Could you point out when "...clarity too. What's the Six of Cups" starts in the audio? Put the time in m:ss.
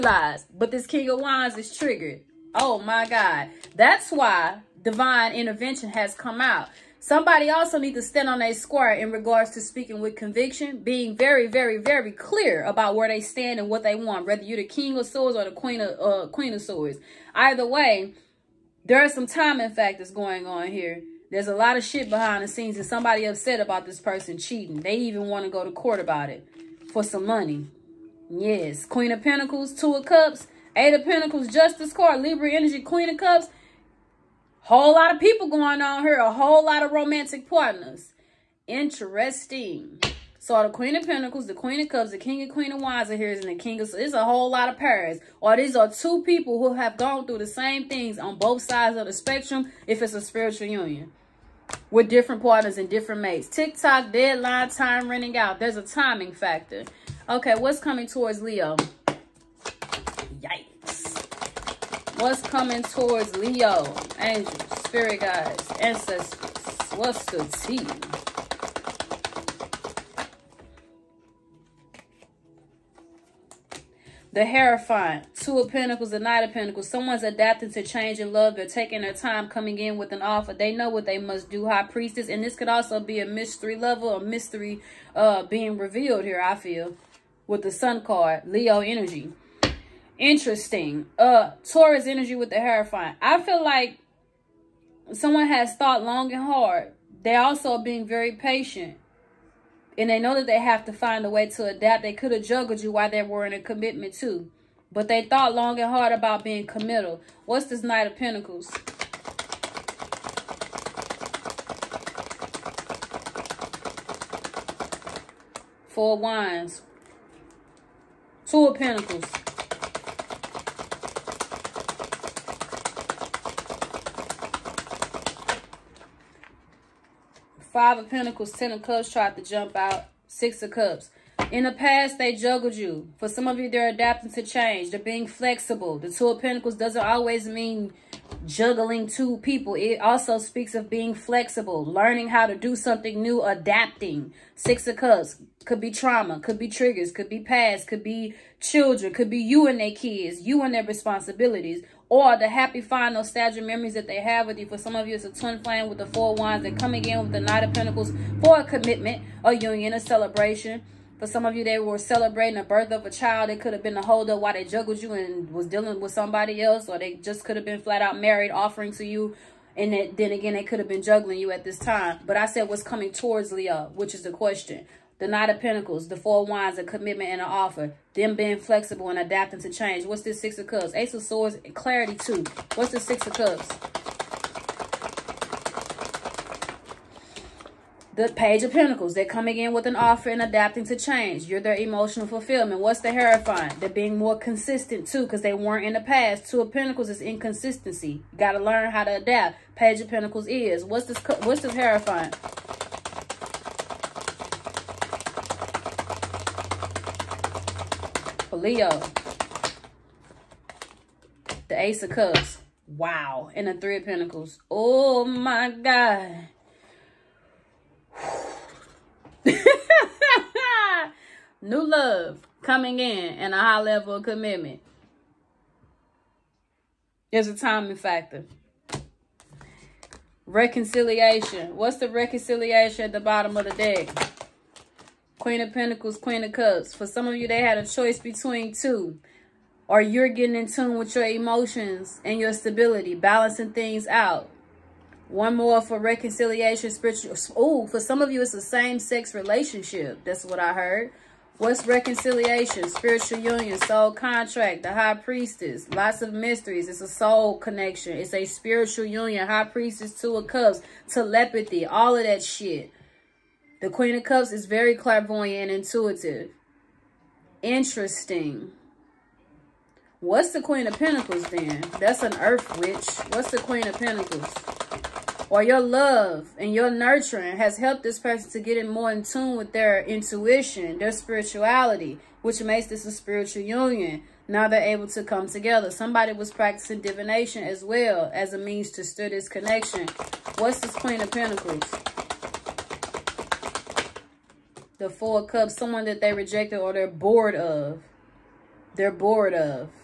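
3:01.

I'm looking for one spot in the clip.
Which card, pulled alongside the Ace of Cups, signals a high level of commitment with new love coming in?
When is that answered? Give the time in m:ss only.
3:33.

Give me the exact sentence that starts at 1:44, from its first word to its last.
But they thought long and hard about being committal.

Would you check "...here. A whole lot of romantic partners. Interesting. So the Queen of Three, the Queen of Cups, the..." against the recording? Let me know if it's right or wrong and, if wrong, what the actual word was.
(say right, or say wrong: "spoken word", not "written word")
wrong: "Pentacles", not "Three".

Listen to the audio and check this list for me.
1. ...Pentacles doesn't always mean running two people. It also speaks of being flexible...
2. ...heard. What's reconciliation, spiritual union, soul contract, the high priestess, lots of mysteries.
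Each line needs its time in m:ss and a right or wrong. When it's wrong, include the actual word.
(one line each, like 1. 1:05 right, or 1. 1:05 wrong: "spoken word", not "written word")
1. 2:16 wrong: "juggling", not "running"
2. 4:10 right.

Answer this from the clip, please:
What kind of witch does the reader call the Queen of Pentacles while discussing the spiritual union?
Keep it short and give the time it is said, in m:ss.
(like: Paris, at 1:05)
Earth Witch, at 4:31.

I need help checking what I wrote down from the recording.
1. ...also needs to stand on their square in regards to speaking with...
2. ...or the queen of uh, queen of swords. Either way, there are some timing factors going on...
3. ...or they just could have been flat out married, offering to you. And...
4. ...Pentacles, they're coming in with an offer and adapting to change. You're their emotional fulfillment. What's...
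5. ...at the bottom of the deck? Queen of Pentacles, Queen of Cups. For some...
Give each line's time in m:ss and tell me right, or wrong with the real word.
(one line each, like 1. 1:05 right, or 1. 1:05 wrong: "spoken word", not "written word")
1. 0:07 right
2. 0:15 right
3. 2:46 right
4. 3:08 right
5. 3:53 right.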